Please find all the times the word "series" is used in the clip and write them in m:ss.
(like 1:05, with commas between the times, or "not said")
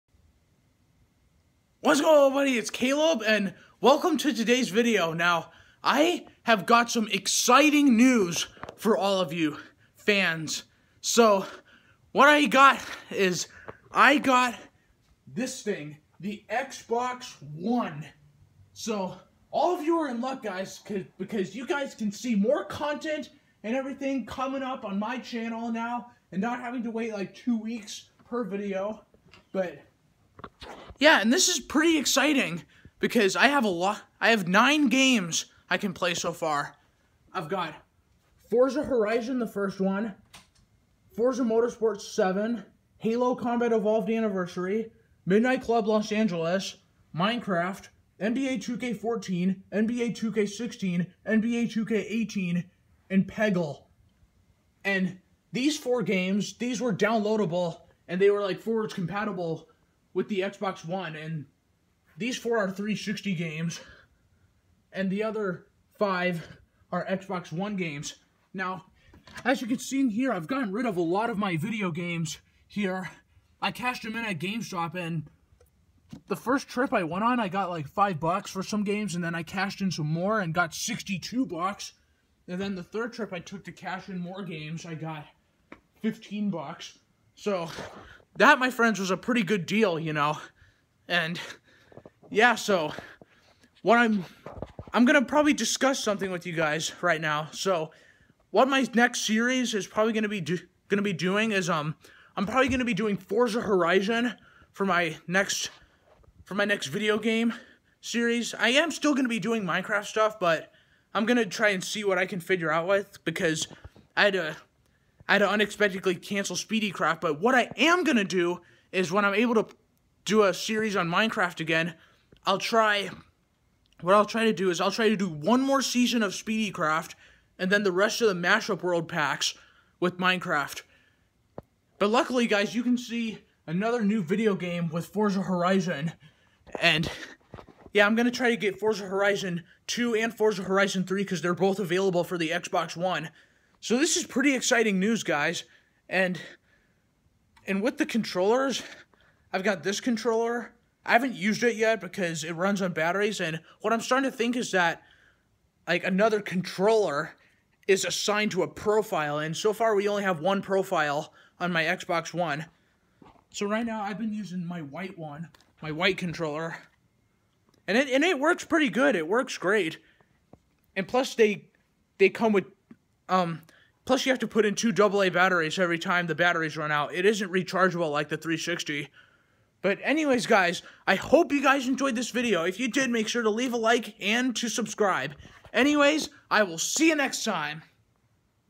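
1:39, 1:48, 2:00.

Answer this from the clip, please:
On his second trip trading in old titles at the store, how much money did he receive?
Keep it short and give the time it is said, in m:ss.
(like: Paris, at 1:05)
$62, at 1:20.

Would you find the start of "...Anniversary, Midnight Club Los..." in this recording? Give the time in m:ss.
0:44.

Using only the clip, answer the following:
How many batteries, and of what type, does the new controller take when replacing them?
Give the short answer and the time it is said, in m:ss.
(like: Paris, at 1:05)
2 AA batteries, at 2:54.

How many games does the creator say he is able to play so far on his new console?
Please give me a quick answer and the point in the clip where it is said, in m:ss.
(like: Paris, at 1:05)
9, at 0:34.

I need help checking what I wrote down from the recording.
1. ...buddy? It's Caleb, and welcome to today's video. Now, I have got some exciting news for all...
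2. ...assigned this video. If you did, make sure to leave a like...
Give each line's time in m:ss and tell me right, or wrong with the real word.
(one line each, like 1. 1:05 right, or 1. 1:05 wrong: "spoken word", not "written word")
1. 0:02 right
2. 3:01 wrong: "enjoyed", not "assigned".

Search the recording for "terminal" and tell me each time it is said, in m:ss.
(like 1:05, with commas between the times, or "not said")
not said.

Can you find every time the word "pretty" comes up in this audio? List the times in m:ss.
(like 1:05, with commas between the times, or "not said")
0:31, 1:29, 2:24, 2:48.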